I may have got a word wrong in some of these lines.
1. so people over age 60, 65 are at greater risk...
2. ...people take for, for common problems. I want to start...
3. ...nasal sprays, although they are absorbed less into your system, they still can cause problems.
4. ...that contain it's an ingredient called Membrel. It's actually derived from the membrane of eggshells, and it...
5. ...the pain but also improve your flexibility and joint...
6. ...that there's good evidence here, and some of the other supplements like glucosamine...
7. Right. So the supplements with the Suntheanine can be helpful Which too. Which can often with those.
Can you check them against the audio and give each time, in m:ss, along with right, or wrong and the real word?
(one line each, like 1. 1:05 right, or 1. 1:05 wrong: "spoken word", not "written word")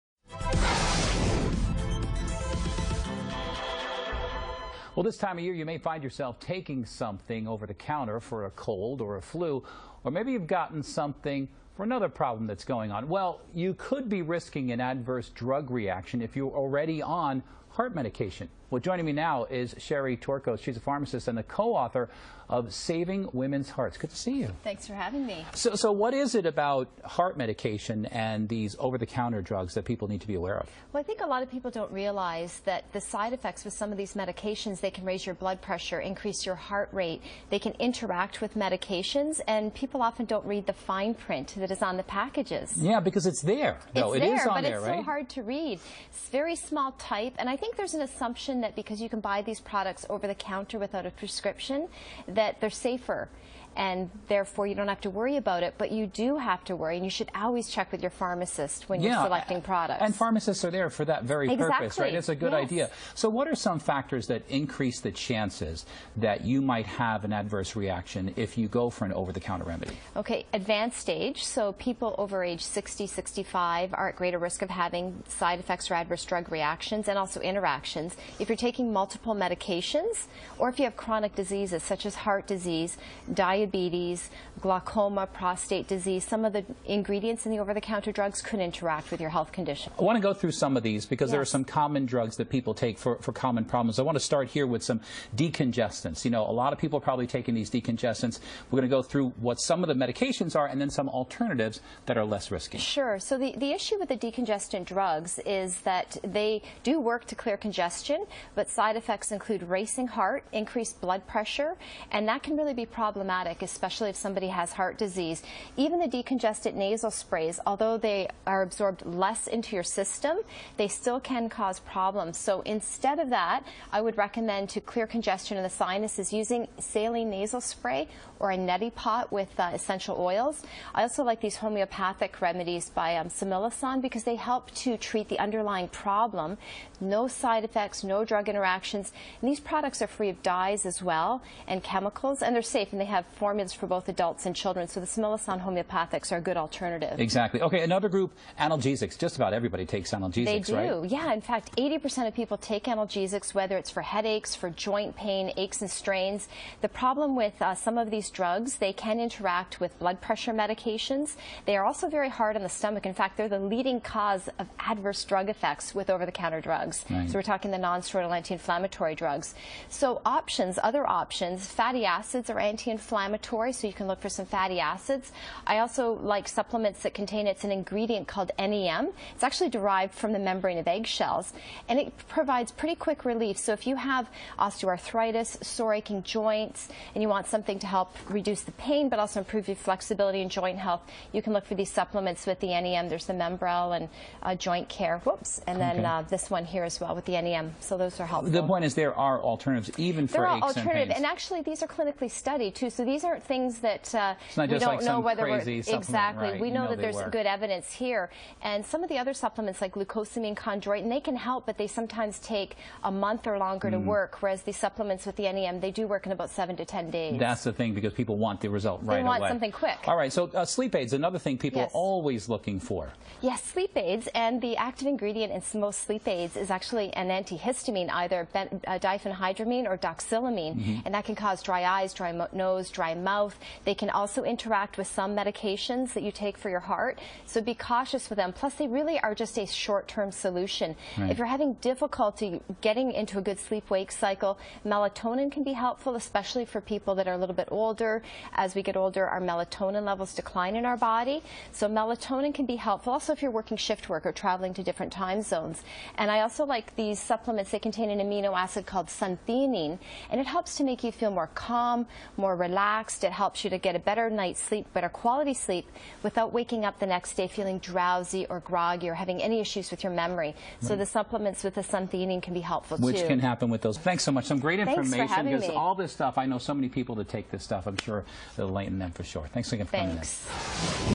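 1. 1:11 right
2. 1:32 right
3. 1:56 right
4. 2:57 wrong: "NEM", not "Membrel"
5. 3:08 right
6. 3:26 right
7. 4:30 wrong: "happen", not "often".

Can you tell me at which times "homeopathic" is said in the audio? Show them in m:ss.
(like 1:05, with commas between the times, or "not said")
2:11, 2:25.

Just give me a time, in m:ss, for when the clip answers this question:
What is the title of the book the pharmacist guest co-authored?
0:22.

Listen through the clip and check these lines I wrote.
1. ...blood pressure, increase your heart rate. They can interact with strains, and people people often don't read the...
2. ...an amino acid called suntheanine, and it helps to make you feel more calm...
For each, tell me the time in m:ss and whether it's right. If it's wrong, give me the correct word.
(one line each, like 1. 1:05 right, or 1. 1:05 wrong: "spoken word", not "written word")
1. 0:35 wrong: "medications", not "strains"
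2. 4:18 right.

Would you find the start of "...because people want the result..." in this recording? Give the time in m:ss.
3:37.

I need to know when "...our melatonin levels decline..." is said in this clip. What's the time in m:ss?
4:09.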